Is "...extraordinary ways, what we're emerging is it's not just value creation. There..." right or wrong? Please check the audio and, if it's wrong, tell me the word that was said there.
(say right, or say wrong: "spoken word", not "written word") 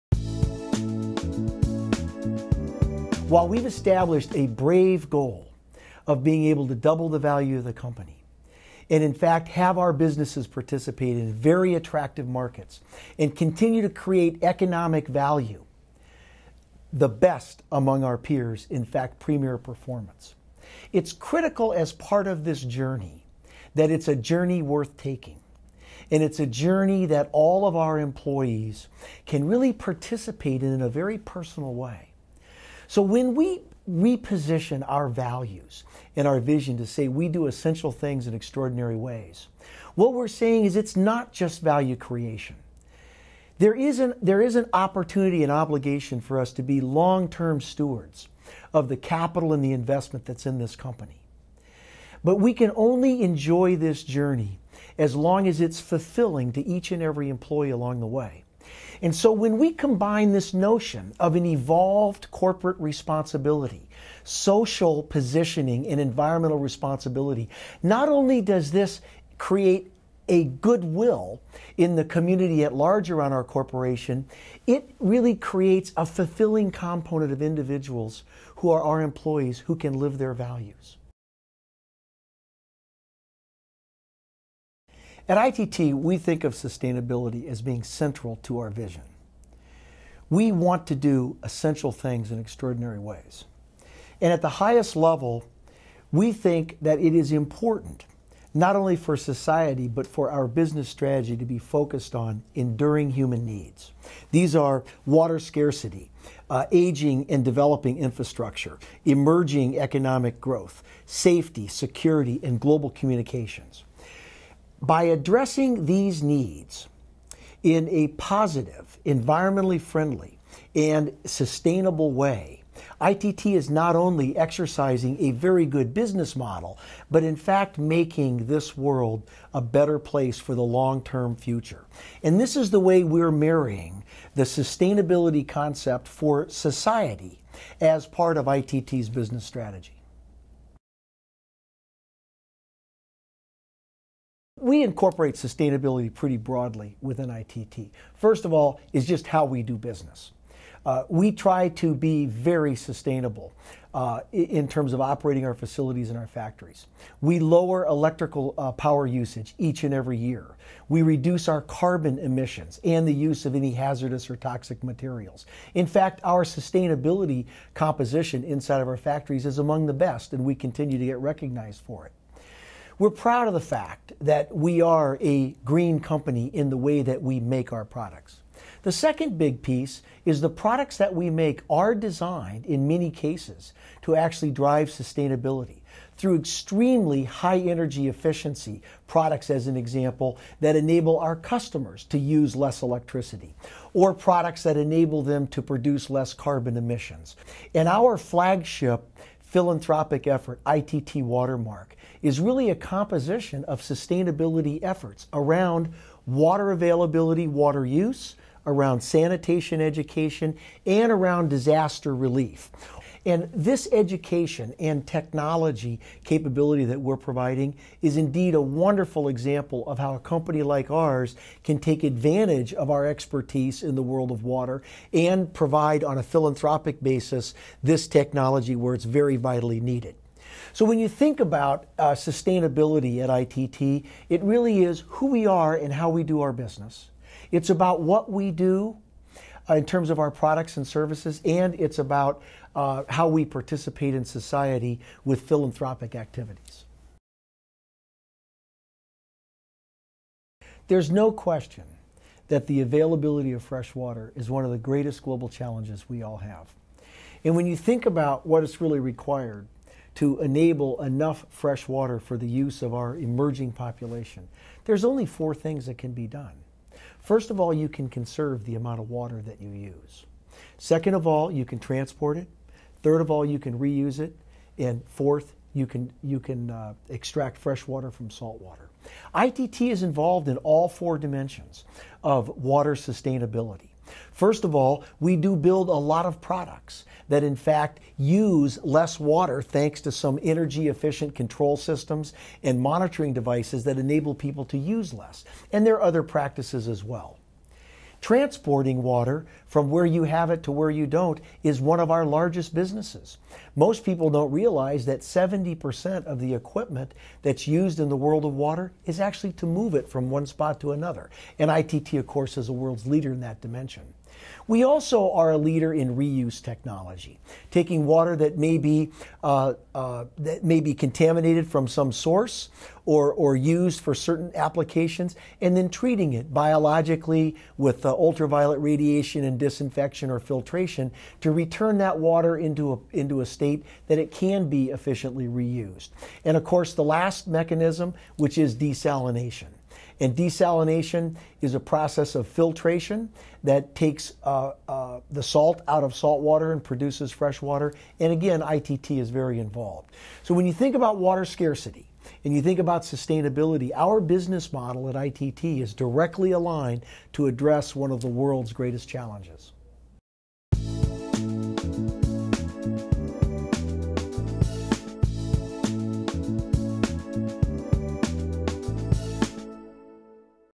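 wrong: "saying", not "emerging".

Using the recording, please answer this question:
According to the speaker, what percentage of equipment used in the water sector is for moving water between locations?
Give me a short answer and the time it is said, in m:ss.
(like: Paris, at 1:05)
70%, at 5:05.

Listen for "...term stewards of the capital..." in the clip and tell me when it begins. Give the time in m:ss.
0:47.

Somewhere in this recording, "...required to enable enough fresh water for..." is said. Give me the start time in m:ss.
4:18.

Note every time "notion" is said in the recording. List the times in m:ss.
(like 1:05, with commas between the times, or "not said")
1:00.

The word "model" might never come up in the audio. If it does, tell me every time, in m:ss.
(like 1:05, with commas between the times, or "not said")
2:06, 5:54.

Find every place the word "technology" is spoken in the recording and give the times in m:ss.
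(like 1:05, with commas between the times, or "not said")
3:35, 3:48, 5:16.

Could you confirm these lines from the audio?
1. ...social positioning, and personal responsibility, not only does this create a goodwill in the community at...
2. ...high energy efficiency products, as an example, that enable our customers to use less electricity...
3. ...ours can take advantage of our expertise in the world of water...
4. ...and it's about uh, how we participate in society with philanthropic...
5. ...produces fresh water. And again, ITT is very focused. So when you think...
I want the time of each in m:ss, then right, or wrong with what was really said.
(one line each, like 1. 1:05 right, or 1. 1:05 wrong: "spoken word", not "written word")
1. 1:04 wrong: "environmental", not "personal"
2. 3:07 right
3. 3:40 right
4. 4:01 right
5. 5:46 wrong: "involved", not "focused".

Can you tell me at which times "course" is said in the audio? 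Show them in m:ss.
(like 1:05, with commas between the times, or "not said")
5:12, 5:36.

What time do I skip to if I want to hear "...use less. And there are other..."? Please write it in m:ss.
4:54.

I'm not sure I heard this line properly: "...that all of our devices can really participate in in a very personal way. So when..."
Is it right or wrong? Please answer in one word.
wrong.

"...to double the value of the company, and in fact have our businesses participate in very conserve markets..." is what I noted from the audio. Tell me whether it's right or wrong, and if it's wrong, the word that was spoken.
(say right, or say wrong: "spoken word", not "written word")
wrong: "attractive", not "conserve".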